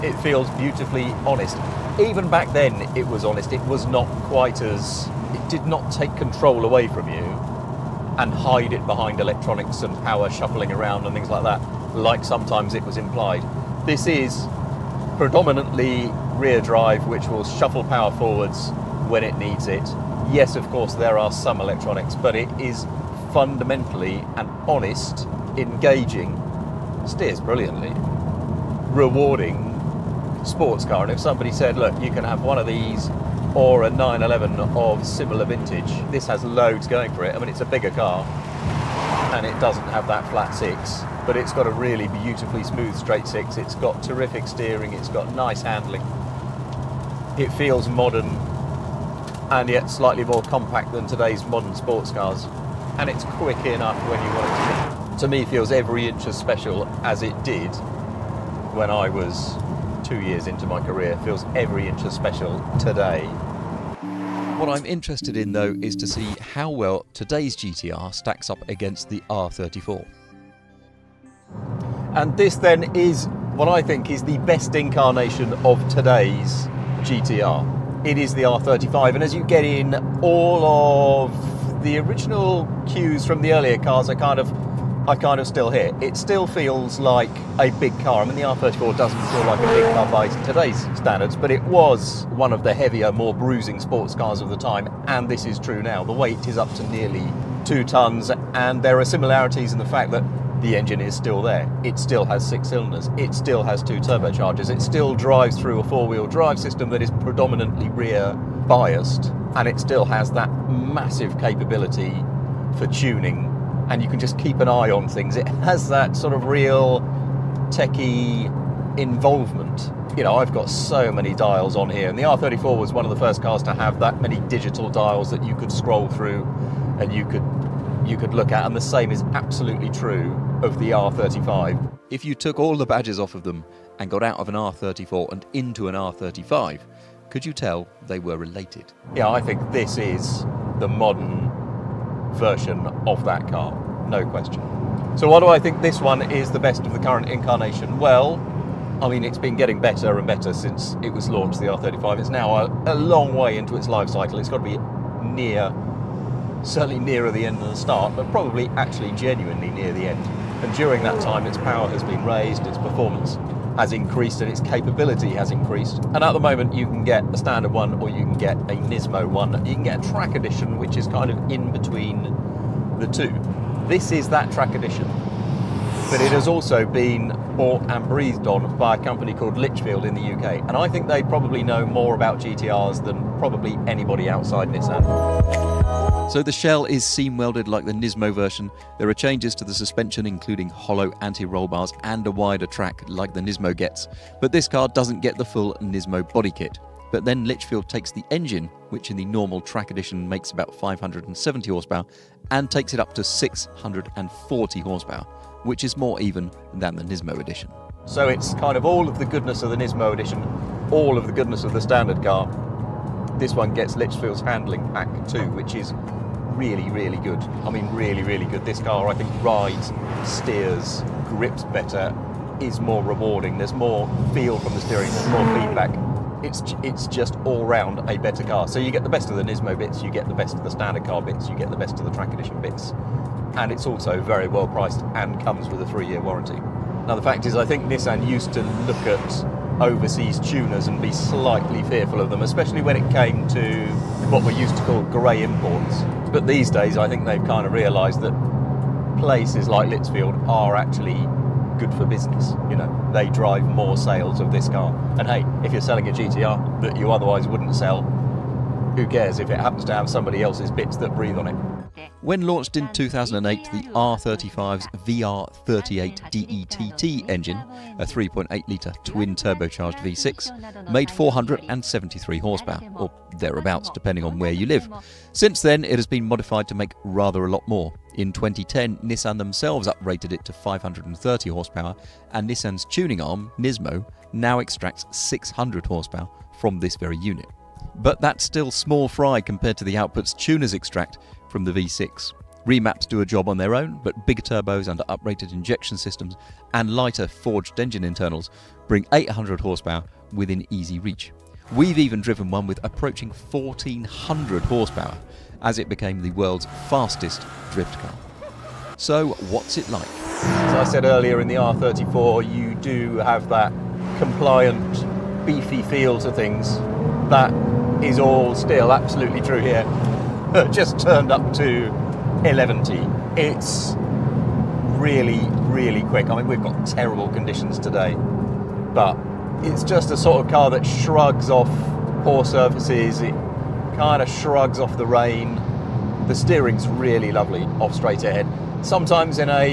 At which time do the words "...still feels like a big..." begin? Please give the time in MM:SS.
01:26.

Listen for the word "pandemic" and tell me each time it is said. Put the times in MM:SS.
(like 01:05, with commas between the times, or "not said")
not said.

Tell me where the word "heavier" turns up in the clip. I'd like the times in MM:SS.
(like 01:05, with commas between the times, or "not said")
01:32.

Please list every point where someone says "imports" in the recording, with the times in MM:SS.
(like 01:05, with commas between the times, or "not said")
04:05.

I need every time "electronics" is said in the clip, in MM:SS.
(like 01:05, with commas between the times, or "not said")
00:09, 00:21.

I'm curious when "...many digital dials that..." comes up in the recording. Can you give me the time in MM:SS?
02:04.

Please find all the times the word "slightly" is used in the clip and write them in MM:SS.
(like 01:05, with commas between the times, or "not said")
00:49, 04:01.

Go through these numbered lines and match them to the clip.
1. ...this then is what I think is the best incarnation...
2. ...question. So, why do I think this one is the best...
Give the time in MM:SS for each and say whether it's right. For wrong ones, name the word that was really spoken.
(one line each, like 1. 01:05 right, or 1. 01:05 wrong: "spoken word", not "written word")
1. 01:12 right
2. 02:24 right.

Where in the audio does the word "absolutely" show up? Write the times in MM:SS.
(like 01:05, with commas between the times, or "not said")
02:09, 05:18.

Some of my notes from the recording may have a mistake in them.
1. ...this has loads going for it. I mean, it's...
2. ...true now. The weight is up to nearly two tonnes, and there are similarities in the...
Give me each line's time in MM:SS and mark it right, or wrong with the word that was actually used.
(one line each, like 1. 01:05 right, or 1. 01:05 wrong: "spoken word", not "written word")
1. 00:36 right
2. 01:35 right.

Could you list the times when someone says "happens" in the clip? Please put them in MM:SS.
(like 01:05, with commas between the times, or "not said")
04:19.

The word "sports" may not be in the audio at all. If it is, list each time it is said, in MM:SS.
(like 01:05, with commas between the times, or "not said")
00:30, 00:51, 01:33.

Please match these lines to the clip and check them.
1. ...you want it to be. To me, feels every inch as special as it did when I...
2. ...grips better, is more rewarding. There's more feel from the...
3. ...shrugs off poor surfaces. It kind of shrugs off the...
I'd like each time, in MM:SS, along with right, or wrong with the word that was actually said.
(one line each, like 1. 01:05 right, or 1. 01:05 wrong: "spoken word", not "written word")
1. 00:54 right
2. 03:41 right
3. 05:30 right.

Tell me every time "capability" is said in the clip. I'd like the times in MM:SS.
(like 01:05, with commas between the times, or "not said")
01:51, 02:44.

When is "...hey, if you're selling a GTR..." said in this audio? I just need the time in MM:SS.
04:15.